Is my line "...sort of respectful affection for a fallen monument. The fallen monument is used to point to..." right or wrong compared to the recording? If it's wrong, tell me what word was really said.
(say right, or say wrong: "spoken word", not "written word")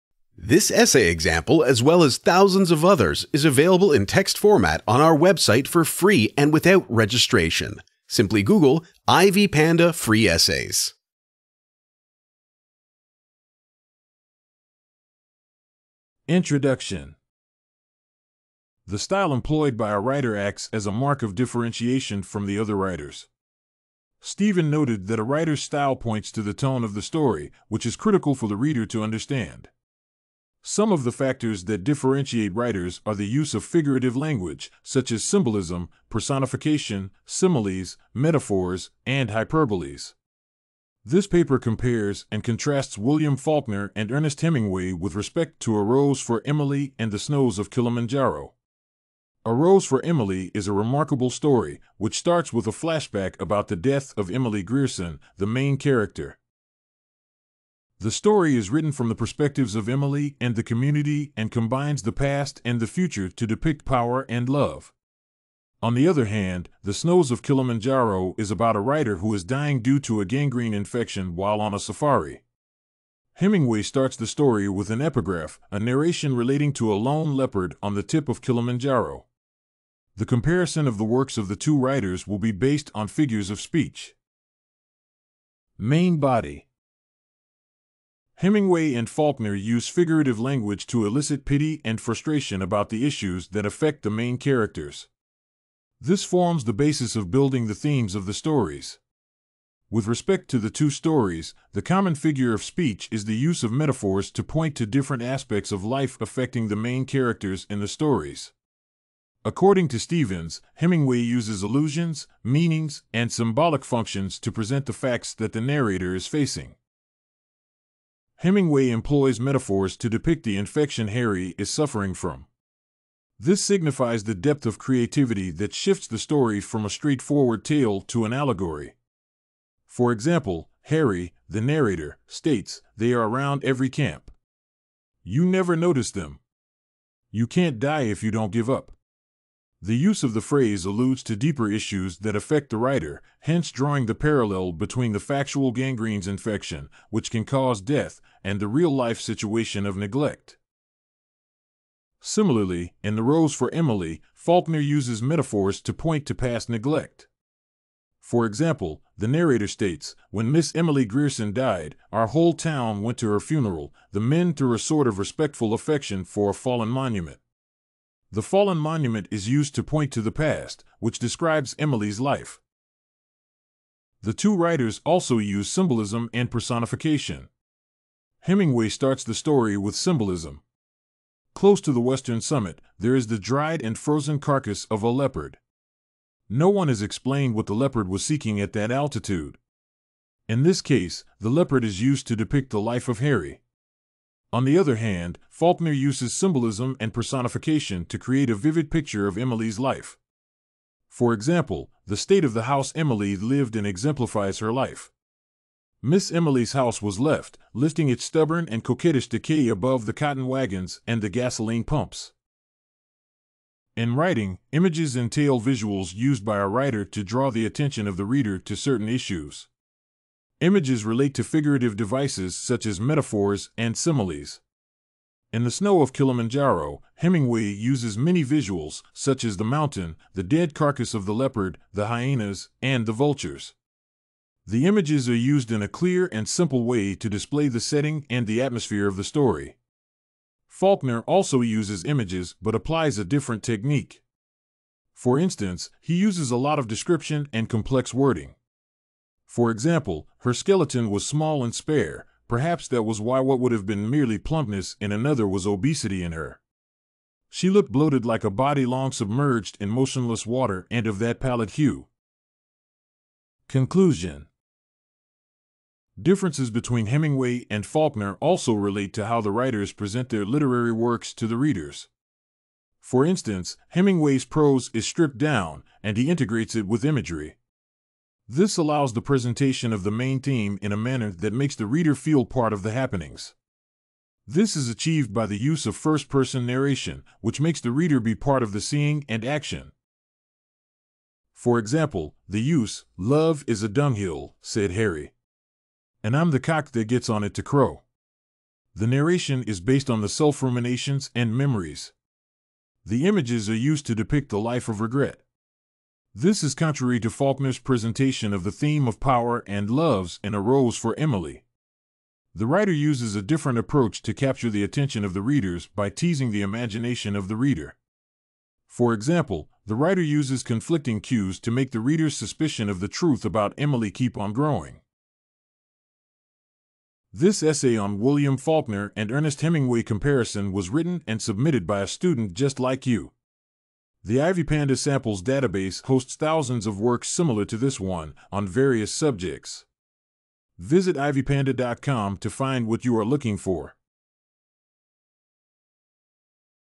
right.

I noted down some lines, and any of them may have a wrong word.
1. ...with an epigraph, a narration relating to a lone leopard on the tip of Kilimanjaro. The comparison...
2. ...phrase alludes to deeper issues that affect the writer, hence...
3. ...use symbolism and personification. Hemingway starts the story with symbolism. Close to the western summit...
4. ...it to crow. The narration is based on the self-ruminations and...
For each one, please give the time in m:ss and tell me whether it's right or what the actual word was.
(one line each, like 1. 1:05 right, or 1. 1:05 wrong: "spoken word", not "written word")
1. 1:14 right
2. 2:20 right
3. 2:55 right
4. 4:57 right.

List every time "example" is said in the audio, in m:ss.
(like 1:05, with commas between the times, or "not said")
0:01, 2:10, 2:38, 3:21, 4:09, 4:51, 5:19.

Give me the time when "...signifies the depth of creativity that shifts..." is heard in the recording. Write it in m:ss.
2:03.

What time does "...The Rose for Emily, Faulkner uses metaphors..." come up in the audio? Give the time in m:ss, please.
2:33.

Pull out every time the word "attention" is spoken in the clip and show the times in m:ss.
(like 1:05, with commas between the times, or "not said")
3:37, 5:14.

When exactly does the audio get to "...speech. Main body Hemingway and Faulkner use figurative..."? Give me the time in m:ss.
1:23.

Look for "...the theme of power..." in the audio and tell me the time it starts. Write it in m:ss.
5:08.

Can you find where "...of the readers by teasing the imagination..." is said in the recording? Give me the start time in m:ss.
5:15.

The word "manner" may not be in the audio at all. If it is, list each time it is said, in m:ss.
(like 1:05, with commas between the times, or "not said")
4:40.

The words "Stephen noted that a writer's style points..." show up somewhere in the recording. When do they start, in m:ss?
0:24.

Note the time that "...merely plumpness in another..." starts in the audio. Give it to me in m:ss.
4:14.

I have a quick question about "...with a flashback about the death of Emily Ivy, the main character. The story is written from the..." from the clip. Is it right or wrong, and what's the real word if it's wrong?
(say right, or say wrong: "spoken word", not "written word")
wrong: "Grierson", not "Ivy".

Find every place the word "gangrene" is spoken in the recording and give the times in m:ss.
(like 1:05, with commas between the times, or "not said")
1:10, 2:25.